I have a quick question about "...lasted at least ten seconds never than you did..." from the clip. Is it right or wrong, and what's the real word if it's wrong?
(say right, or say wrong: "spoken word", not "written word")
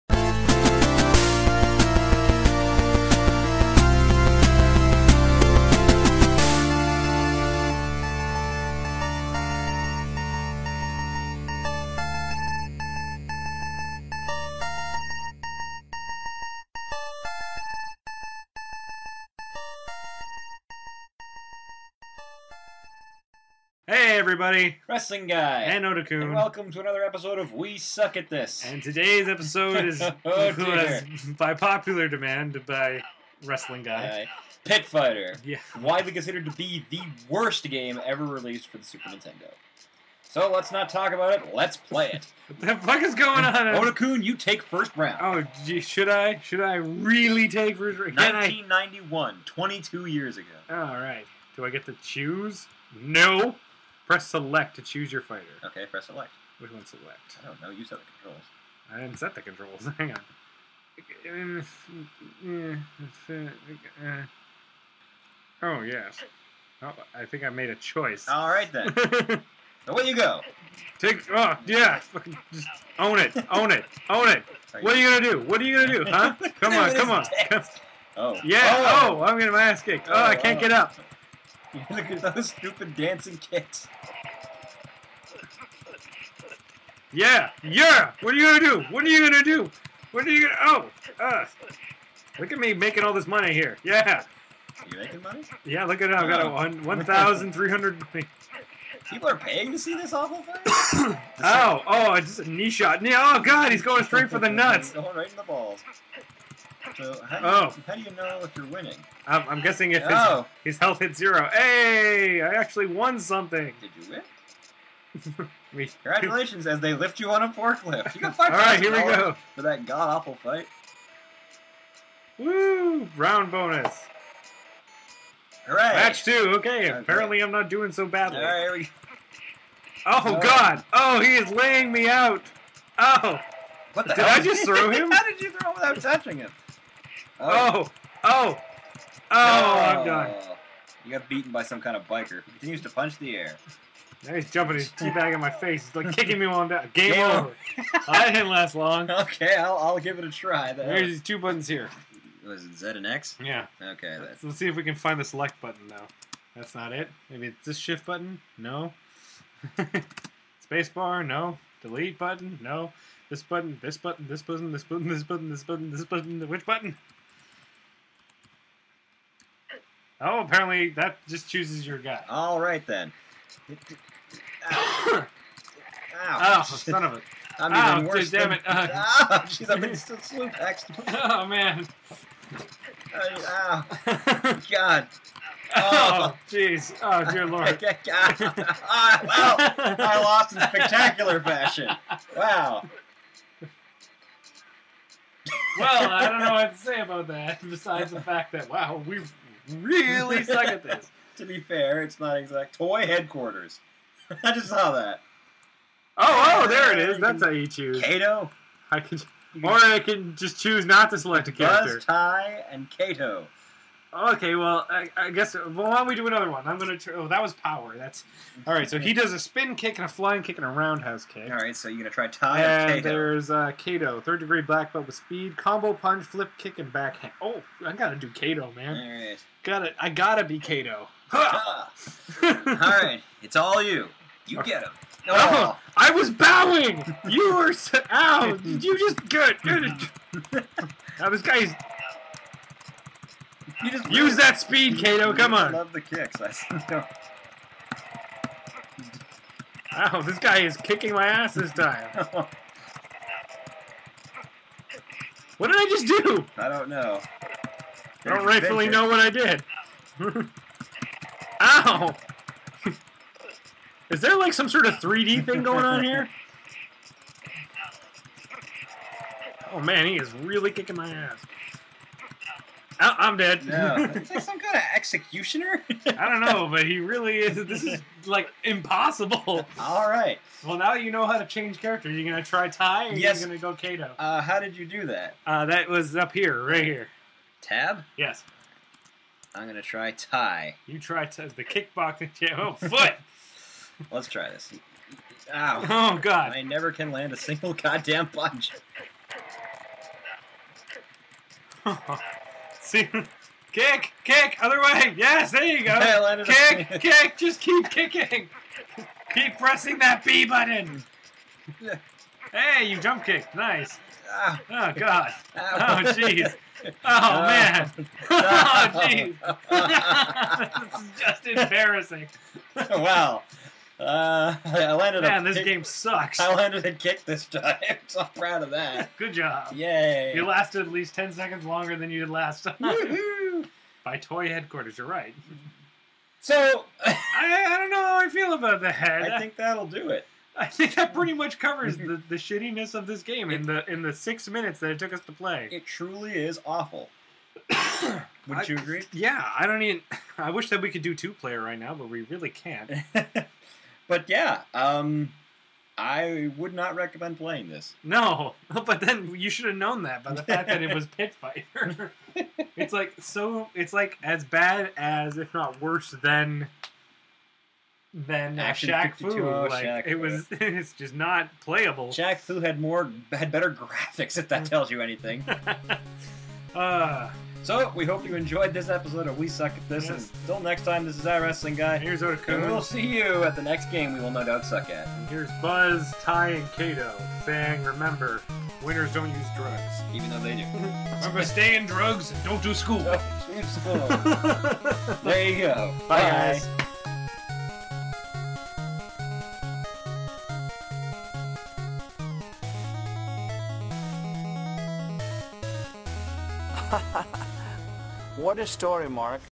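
wrong: "longer", not "never".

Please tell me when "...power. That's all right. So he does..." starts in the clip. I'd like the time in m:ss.
3:37.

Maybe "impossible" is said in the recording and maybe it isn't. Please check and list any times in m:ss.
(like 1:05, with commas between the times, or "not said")
4:38.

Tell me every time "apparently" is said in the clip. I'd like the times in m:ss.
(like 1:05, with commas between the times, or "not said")
2:06, 2:50.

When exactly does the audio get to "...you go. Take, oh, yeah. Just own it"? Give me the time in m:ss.
1:10.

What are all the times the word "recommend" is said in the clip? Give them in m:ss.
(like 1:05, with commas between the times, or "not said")
5:56.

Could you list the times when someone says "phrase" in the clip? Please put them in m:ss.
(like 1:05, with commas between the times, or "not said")
not said.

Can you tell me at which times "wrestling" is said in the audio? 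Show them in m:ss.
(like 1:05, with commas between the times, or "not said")
0:24, 0:33, 6:21.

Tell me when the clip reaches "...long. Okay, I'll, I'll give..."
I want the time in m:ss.
2:28.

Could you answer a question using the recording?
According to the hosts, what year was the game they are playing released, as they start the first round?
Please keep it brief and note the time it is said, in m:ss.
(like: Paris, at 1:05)
1991, at 0:48.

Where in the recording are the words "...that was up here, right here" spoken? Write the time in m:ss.
4:45.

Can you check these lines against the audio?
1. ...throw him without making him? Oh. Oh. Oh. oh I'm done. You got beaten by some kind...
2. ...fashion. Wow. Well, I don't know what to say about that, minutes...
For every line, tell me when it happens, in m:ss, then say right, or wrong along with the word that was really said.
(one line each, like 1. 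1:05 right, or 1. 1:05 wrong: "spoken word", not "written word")
1. 2:15 wrong: "touching", not "making"
2. 3:11 wrong: "besides", not "minutes".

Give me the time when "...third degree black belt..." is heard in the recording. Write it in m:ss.
3:44.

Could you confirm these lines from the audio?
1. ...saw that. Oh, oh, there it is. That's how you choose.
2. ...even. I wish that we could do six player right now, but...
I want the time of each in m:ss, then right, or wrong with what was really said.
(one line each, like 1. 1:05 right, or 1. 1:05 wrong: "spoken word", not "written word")
1. 3:24 right
2. 5:49 wrong: "two", not "six".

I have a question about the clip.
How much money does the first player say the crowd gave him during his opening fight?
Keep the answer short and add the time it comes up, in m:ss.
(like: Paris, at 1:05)
1,300, at 1:36.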